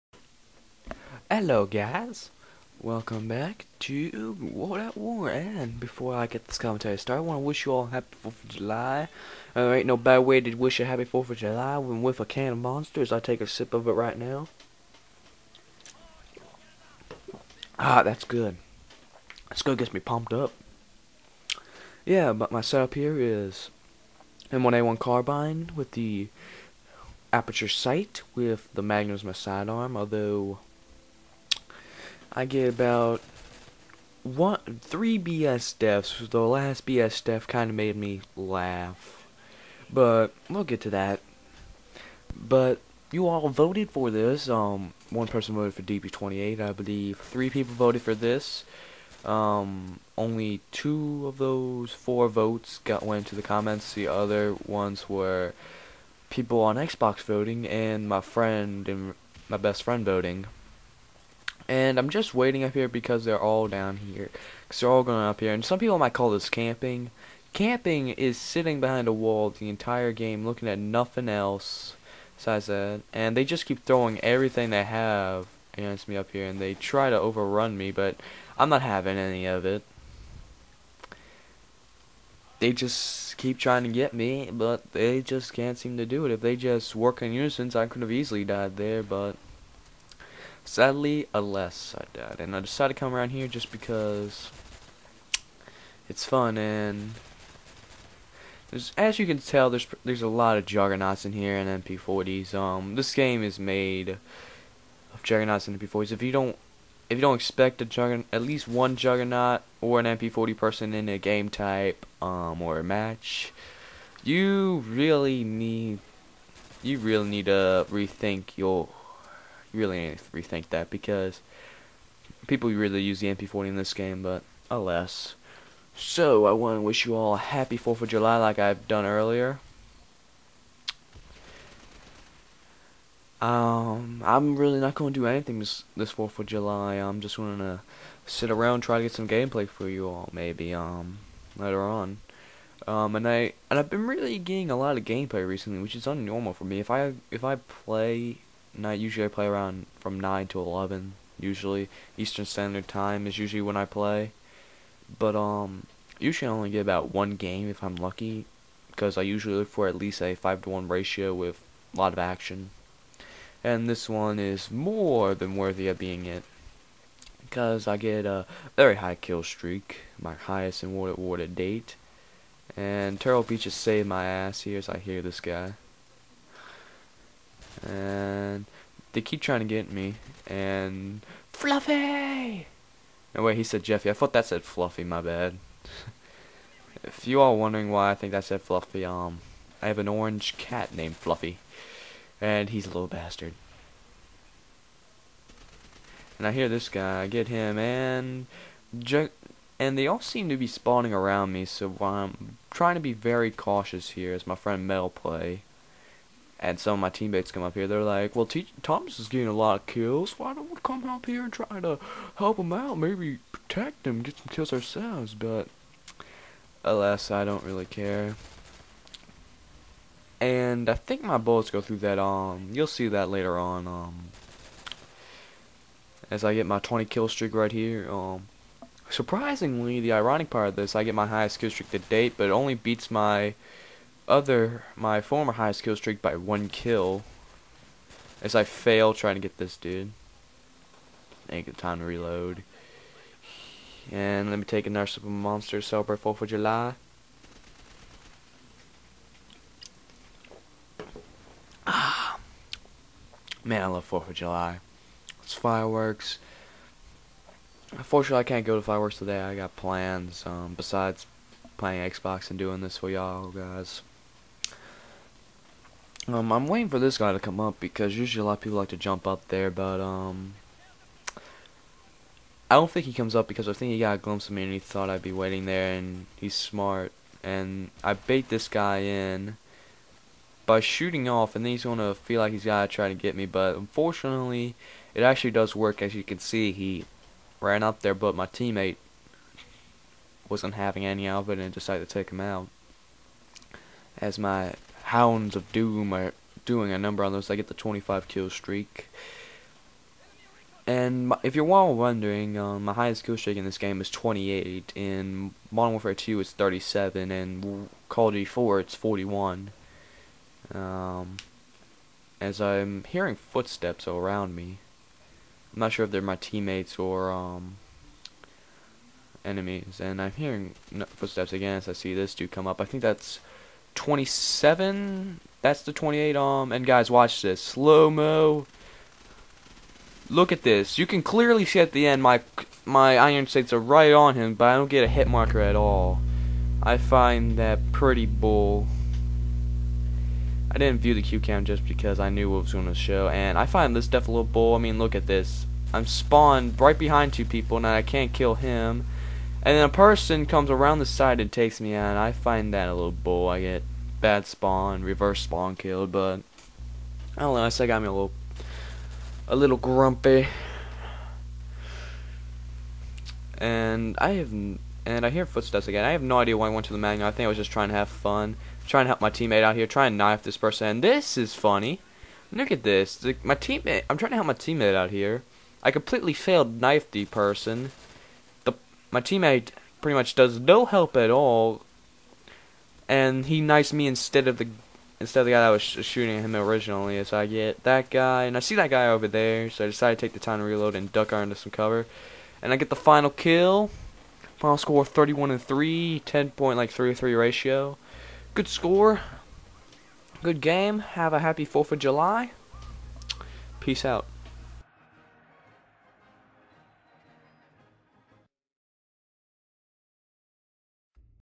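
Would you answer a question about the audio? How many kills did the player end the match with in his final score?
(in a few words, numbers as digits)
31.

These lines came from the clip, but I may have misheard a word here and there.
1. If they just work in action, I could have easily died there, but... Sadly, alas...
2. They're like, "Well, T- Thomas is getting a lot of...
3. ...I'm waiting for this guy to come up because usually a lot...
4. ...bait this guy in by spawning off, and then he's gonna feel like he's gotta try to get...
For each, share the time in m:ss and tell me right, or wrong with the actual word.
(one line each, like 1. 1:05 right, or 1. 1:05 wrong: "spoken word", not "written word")
1. 1:26 wrong: "unison", not "action"
2. 3:27 right
3. 4:26 right
4. 4:38 wrong: "shooting", not "spawning".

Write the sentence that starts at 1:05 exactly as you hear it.
And some people might call this camping.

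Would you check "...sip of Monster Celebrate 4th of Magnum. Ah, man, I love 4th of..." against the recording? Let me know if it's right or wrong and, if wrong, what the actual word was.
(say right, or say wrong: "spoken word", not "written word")
wrong: "July", not "Magnum".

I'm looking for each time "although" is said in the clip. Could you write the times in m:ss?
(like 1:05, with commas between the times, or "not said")
0:29.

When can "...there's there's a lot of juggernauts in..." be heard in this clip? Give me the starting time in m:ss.
1:39.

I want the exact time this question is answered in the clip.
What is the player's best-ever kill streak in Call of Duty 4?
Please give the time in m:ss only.
5:08.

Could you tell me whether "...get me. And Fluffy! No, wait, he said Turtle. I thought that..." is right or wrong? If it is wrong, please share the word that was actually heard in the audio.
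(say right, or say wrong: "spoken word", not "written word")
wrong: "Jeffy", not "Turtle".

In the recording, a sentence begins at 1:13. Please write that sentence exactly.
And they just keep throwing everything they have against me up here.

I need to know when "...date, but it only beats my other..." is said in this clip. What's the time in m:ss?
3:51.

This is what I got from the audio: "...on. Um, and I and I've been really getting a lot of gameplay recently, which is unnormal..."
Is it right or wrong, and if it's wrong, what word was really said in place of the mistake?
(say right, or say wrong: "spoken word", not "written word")
right.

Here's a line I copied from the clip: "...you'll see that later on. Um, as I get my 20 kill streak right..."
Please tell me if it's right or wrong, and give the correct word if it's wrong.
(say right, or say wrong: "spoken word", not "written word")
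right.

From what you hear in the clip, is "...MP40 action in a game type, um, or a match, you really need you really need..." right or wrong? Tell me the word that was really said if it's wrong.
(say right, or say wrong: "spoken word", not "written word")
wrong: "person", not "action".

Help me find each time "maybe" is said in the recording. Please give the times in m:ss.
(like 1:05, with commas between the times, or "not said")
2:20, 3:32.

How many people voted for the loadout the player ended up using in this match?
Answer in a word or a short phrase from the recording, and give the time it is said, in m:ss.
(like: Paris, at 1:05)
3, at 0:47.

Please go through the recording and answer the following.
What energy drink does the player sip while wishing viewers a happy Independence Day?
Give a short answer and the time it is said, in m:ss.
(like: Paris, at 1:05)
Monster, at 0:12.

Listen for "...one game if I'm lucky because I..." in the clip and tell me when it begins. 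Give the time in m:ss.
2:37.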